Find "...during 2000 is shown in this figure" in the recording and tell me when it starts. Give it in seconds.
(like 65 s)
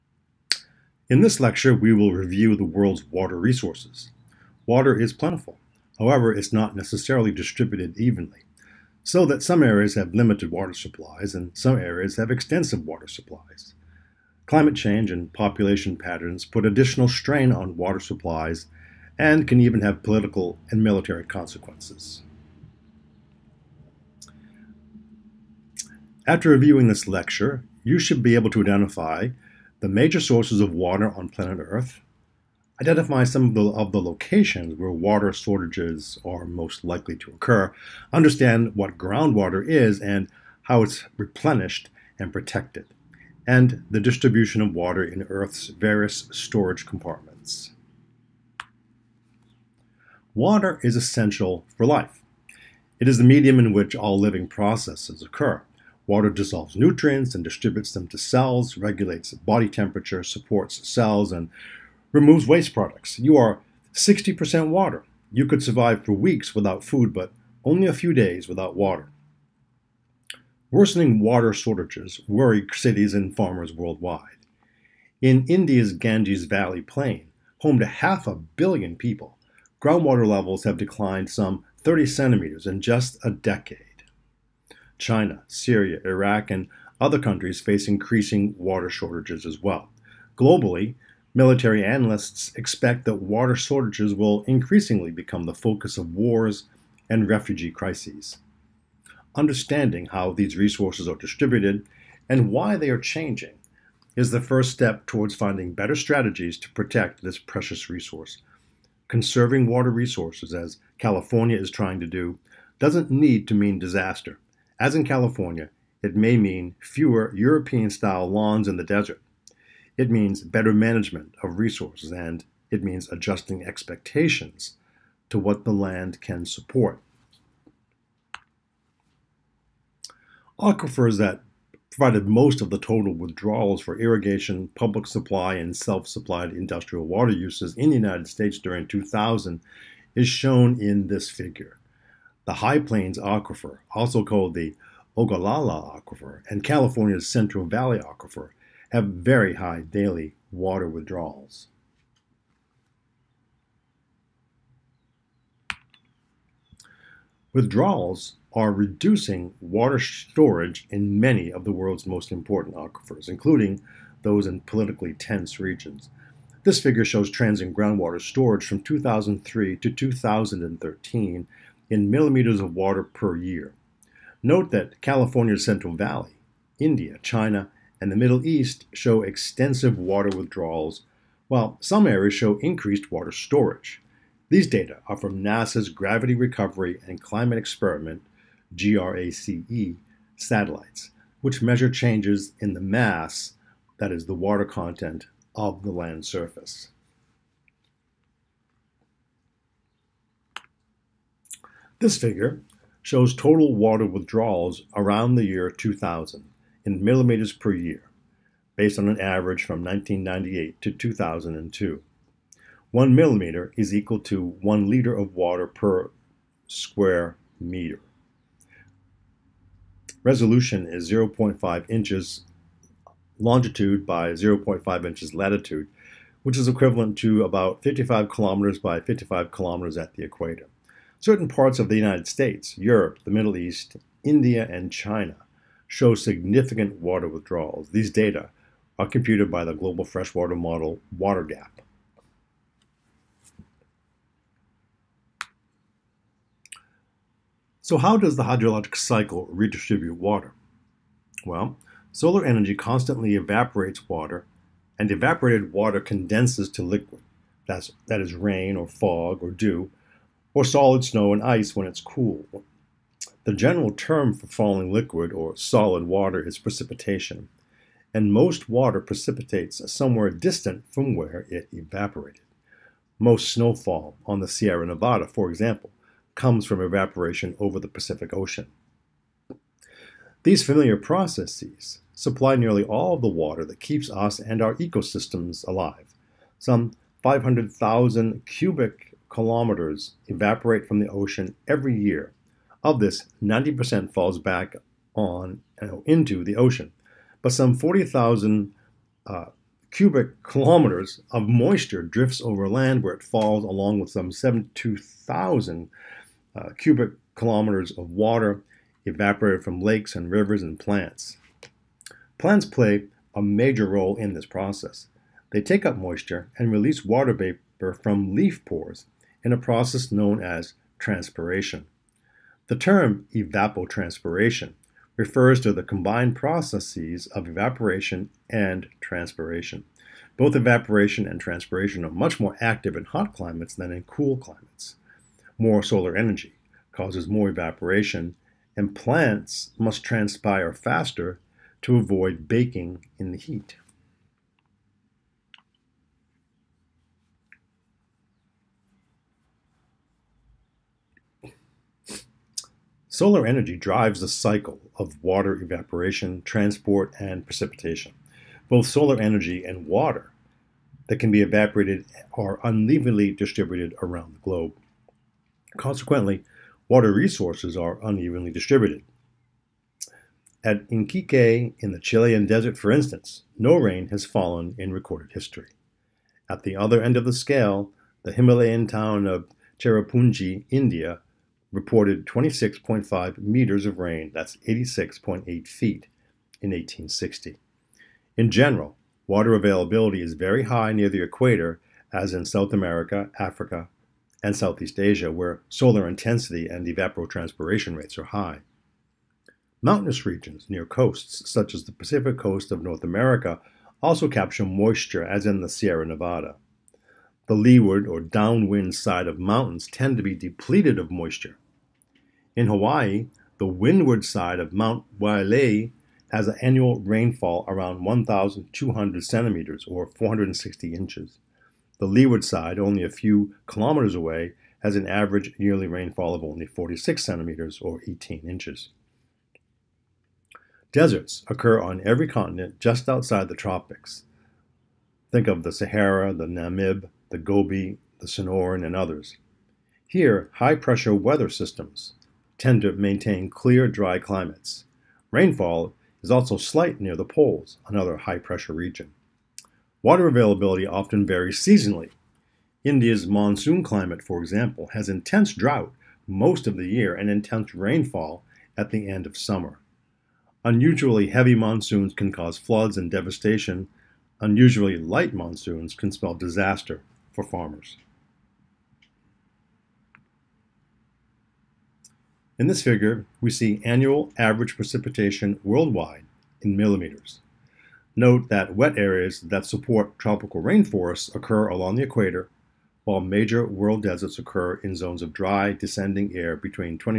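138 s.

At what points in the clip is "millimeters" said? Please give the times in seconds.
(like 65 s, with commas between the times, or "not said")
172 s, 207 s, 213 s, 476 s.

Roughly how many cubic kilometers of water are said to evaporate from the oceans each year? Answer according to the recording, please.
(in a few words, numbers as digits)
500,000 cubic kilometers.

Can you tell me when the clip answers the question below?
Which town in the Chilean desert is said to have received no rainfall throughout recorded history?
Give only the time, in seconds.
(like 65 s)
370 s.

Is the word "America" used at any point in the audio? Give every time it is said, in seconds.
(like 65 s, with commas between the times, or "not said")
392 s, 403 s.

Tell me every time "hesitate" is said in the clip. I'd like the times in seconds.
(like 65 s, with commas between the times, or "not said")
not said.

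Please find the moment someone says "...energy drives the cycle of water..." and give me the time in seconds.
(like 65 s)
353 s.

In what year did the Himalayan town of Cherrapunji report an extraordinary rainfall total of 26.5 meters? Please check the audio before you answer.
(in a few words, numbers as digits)
1860.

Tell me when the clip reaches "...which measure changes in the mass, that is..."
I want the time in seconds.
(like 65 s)
191 s.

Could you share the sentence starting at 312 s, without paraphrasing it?
Plants play a major role in this process.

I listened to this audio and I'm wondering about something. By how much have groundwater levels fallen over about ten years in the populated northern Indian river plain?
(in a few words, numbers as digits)
30 centimeters.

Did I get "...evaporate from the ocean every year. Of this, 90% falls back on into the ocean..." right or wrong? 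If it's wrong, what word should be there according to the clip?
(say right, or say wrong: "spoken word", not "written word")
right.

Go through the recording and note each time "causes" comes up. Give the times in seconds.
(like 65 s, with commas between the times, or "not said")
336 s, 462 s.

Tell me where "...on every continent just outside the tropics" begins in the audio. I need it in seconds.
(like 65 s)
431 s.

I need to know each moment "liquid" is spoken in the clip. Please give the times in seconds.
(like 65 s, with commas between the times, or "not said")
256 s, 264 s.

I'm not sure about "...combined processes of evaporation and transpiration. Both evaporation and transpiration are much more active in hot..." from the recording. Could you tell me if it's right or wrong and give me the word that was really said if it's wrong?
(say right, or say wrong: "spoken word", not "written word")
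right.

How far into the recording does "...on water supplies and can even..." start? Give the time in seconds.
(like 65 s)
17 s.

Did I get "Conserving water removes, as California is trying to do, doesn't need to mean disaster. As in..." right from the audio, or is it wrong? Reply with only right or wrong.
wrong.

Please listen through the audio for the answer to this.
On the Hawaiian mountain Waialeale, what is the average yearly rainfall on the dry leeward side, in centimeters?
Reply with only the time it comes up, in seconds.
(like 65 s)
426 s.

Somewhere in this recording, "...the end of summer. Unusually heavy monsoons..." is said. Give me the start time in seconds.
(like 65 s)
458 s.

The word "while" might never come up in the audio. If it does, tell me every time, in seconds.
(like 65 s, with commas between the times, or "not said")
181 s, 483 s.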